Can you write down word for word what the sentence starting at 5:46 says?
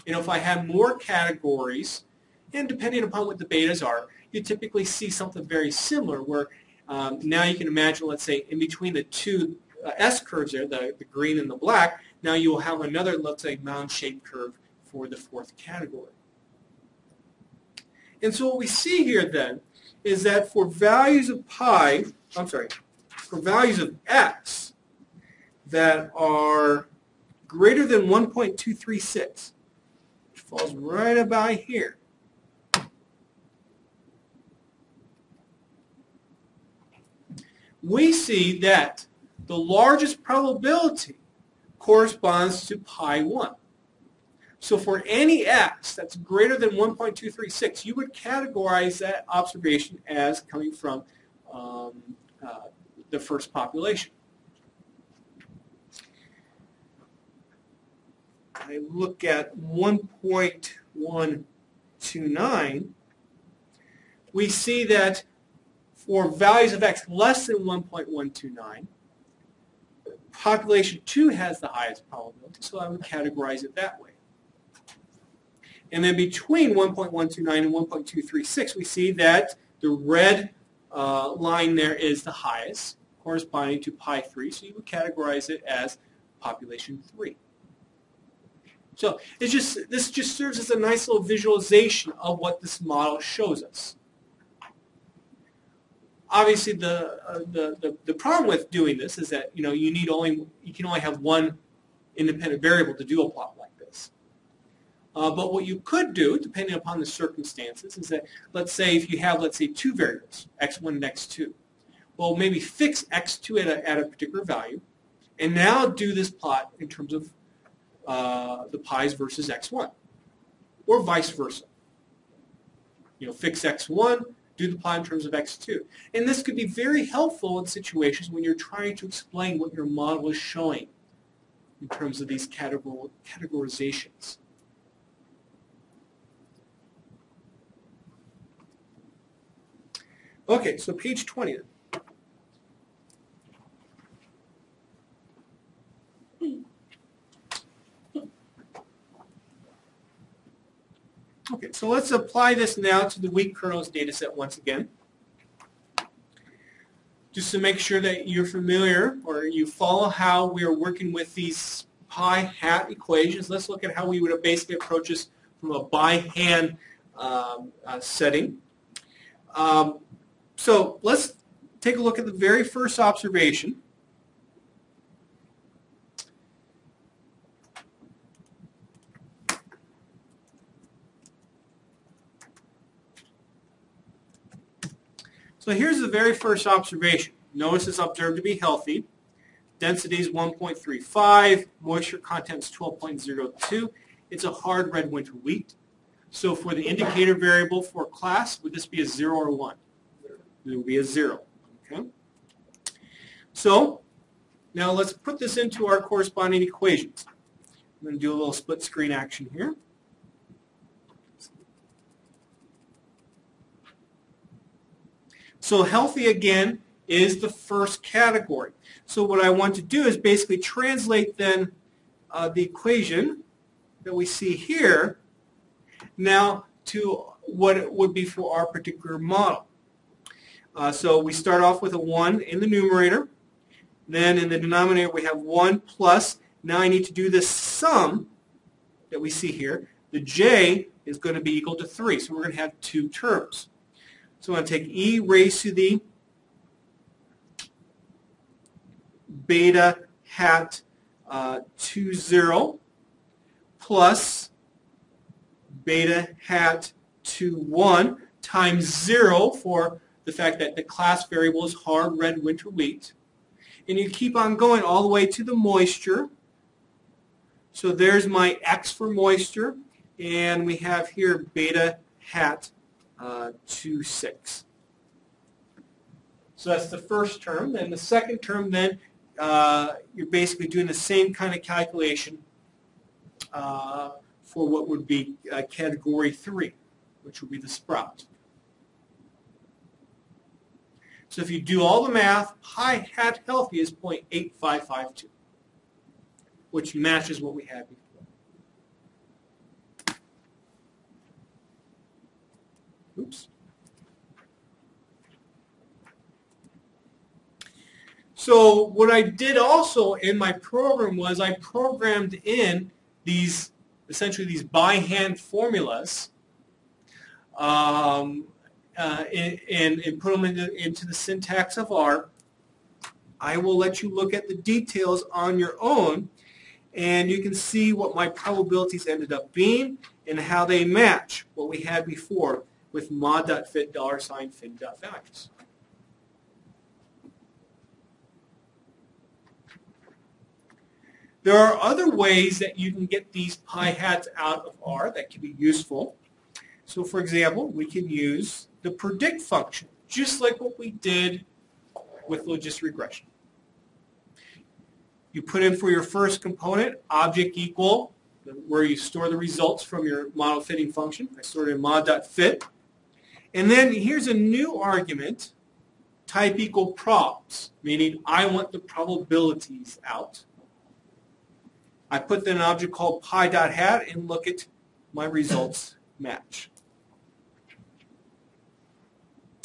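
So for example, we can use the predict function, just like what we did with logistic regression.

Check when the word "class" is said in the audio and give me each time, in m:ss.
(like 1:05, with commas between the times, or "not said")
3:18, 4:20.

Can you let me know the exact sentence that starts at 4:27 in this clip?
So there's my x for moisture.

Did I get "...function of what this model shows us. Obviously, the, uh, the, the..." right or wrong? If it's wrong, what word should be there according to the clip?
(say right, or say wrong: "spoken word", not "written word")
wrong: "visualization", not "function".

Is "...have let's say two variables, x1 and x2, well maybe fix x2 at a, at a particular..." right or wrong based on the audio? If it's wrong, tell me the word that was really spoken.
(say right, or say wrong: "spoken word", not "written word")
right.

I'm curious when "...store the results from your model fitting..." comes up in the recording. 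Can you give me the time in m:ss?
5:58.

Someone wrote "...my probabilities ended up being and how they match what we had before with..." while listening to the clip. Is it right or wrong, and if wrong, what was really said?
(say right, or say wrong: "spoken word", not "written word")
right.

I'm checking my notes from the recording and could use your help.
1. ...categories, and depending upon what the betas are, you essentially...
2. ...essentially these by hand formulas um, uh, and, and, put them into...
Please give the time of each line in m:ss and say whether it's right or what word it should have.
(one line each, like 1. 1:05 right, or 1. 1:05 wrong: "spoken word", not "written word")
1. 0:00 wrong: "typically", not "essentially"
2. 5:14 right.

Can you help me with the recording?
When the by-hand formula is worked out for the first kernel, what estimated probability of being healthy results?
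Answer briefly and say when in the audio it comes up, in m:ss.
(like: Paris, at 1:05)
0.8552, at 4:53.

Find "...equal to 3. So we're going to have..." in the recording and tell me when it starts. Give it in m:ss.
4:01.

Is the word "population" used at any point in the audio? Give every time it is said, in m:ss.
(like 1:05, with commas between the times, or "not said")
0:53, 1:10, 1:26.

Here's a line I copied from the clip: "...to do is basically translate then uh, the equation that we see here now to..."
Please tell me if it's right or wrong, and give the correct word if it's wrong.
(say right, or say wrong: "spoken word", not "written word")
right.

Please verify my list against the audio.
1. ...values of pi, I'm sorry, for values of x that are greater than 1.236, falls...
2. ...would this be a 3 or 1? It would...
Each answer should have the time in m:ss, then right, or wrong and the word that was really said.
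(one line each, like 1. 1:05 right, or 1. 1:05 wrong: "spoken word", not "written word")
1. 0:20 right
2. 3:18 wrong: "0", not "3".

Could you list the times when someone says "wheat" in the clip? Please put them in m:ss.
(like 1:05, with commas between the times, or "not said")
2:33, 3:15, 4:22.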